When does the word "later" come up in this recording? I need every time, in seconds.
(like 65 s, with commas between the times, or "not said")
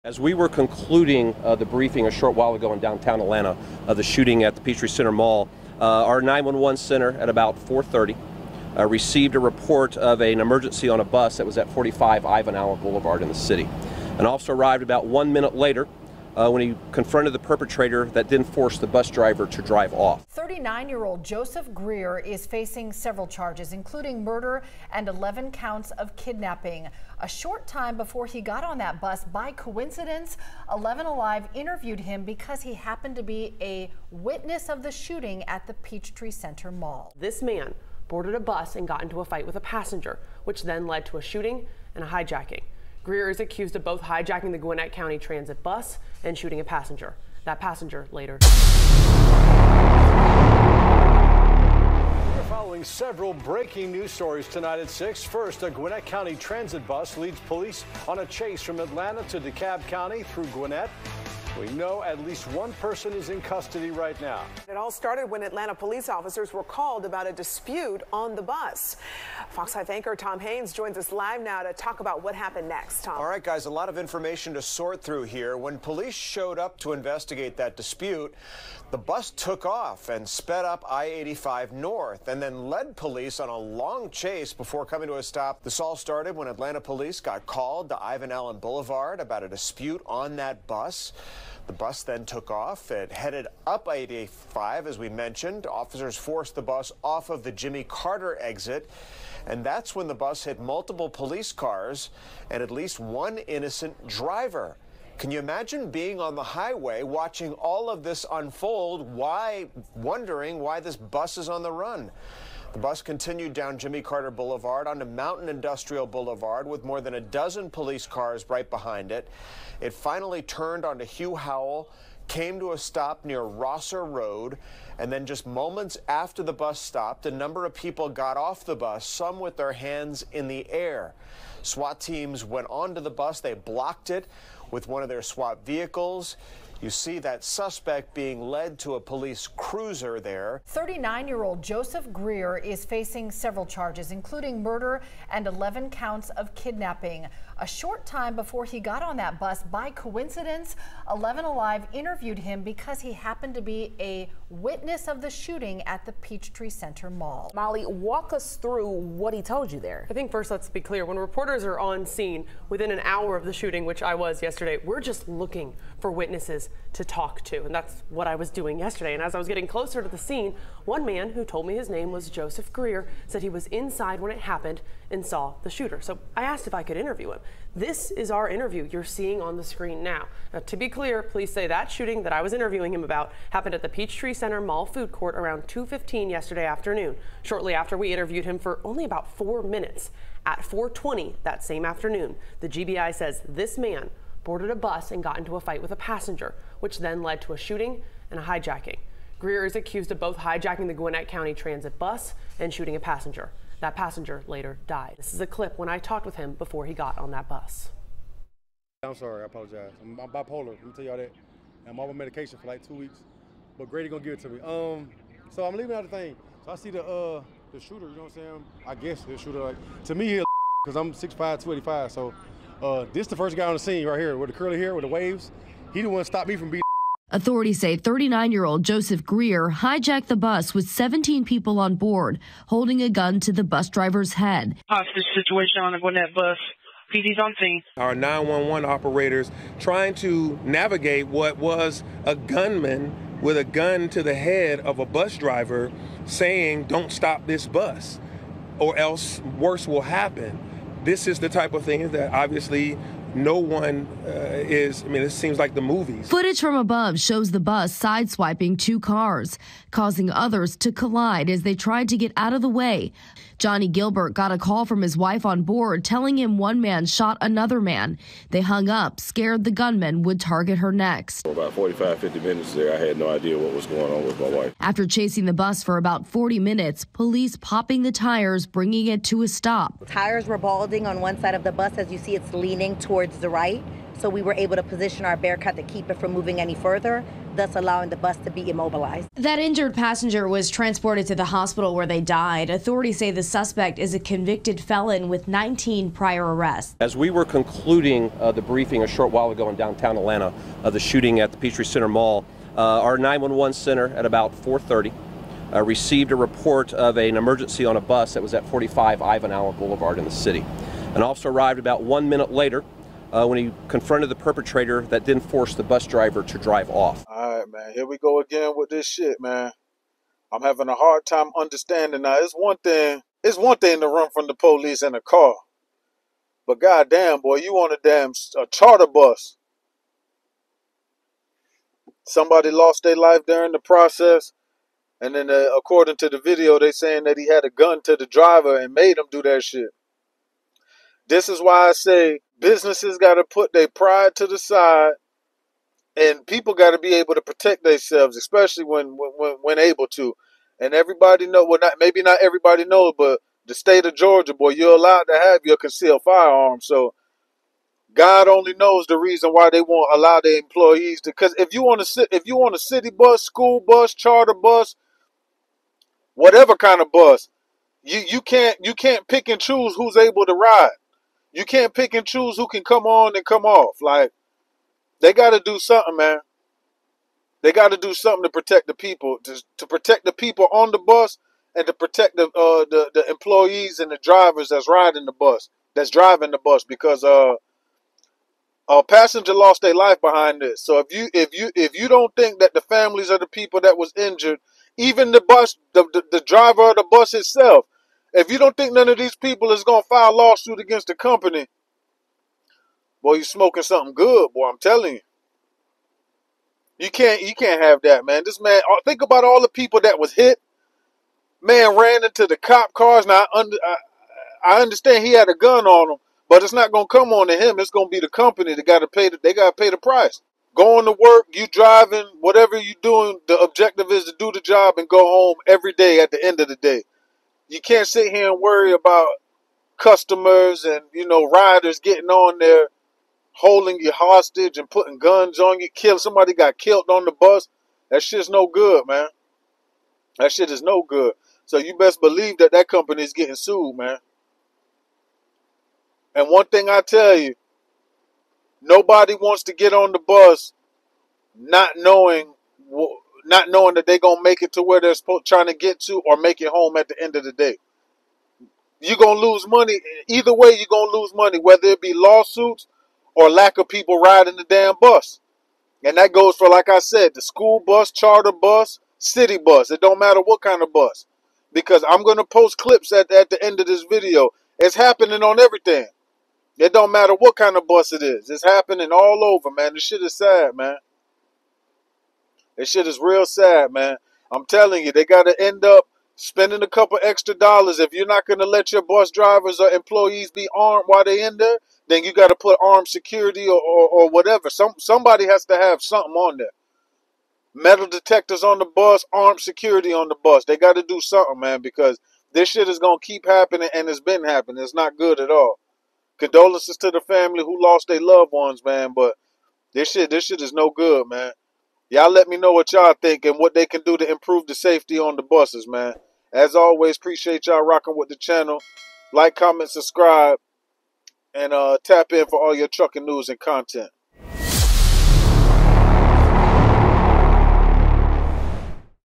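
15 s, 48 s, 204 s, 312 s.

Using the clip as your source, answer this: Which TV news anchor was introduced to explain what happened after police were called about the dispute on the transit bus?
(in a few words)
Tom Haynes.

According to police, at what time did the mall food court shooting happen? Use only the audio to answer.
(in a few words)
2:15.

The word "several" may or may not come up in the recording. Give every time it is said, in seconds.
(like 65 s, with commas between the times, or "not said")
22 s, 52 s, 143 s.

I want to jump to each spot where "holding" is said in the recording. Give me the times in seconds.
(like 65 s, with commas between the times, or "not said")
232 s, 433 s.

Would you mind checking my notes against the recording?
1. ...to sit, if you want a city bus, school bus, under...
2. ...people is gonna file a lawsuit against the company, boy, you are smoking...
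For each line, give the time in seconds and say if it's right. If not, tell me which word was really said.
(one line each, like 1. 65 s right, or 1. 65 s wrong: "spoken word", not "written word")
1. 361 s wrong: "charter", not "under"
2. 399 s right.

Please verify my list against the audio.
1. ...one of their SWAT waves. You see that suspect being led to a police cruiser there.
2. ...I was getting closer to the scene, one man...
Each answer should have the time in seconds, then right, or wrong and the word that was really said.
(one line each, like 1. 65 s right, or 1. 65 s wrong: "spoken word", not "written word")
1. 134 s wrong: "vehicles", not "waves"
2. 169 s right.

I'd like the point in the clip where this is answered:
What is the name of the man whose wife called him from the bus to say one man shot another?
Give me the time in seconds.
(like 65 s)
263 s.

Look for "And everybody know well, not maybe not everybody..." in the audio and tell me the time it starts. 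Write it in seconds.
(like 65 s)
350 s.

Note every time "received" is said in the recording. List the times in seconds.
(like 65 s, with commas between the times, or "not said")
8 s, 305 s.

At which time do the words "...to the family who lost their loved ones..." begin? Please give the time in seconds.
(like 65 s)
506 s.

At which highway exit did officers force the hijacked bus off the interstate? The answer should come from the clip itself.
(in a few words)
Jimmy Carter exit.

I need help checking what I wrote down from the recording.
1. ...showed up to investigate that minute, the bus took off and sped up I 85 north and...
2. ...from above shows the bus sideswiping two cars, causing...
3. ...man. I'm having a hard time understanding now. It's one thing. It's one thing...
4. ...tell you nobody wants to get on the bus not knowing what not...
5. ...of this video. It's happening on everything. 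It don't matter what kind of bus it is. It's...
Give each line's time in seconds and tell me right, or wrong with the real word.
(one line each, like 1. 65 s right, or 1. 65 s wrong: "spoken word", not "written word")
1. 76 s wrong: "dispute", not "minute"
2. 256 s right
3. 319 s right
4. 446 s right
5. 473 s right.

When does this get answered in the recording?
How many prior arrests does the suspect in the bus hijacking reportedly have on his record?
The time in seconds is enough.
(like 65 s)
295 s.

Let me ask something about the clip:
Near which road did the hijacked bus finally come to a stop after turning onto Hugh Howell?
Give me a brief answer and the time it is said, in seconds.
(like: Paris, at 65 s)
Rosser Road, at 123 s.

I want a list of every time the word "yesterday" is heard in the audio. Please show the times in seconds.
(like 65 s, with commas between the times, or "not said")
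164 s, 168 s, 186 s.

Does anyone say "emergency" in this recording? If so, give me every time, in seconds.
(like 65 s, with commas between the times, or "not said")
10 s, 307 s.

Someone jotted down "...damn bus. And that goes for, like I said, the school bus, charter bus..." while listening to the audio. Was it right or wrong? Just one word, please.
right.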